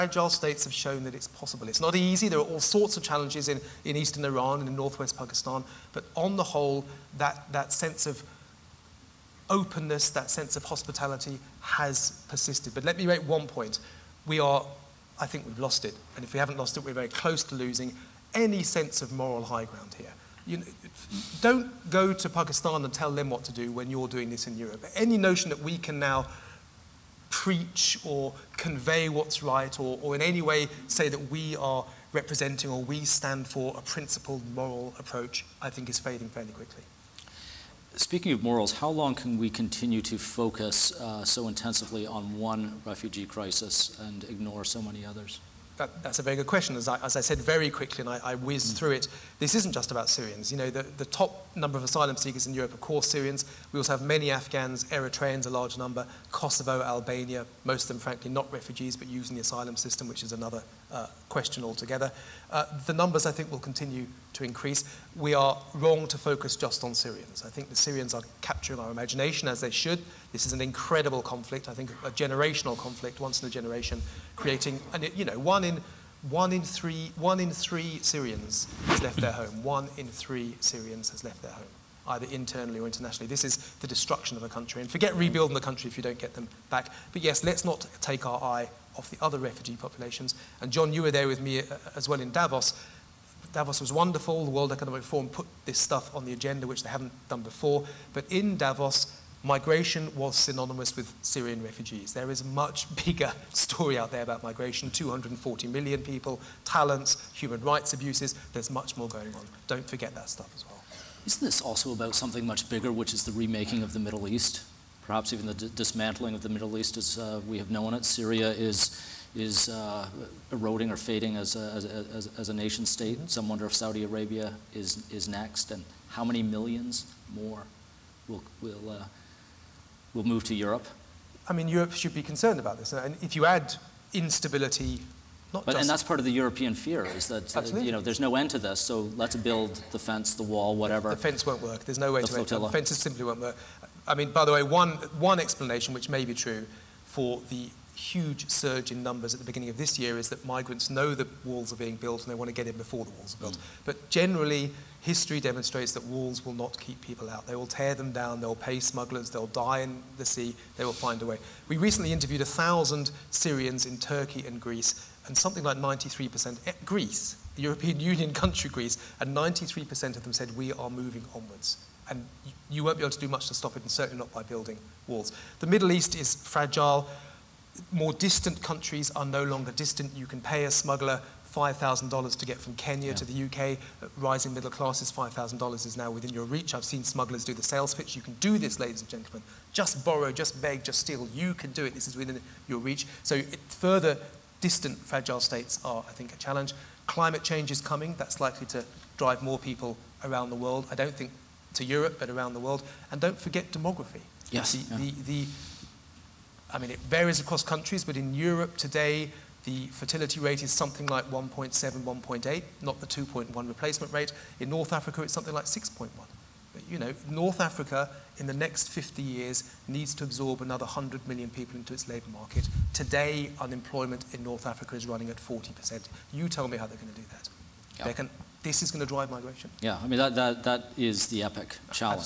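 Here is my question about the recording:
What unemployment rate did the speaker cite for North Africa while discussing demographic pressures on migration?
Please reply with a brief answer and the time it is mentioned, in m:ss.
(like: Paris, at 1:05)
40%, at 3:45.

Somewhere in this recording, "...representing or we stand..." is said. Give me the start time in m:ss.
0:32.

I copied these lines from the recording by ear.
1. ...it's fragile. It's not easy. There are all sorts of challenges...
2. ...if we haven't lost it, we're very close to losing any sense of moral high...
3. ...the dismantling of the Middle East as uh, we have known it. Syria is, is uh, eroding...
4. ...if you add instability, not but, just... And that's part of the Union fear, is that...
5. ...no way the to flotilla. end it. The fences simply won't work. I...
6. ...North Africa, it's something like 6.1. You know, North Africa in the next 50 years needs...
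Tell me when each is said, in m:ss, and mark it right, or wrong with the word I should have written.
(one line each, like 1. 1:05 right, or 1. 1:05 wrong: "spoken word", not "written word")
1. 0:01 wrong: "possible", not "fragile"
2. 0:16 right
3. 1:55 right
4. 2:13 wrong: "European", not "Union"
5. 2:21 right
6. 3:34 right.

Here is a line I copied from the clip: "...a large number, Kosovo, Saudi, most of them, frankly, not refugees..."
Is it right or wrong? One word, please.
wrong.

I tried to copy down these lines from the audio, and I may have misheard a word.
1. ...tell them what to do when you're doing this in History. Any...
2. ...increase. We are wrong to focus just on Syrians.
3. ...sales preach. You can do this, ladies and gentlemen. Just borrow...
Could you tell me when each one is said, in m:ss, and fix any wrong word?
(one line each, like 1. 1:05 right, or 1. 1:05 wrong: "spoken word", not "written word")
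1. 0:22 wrong: "Europe", not "History"
2. 1:04 right
3. 3:07 wrong: "pitch", not "preach".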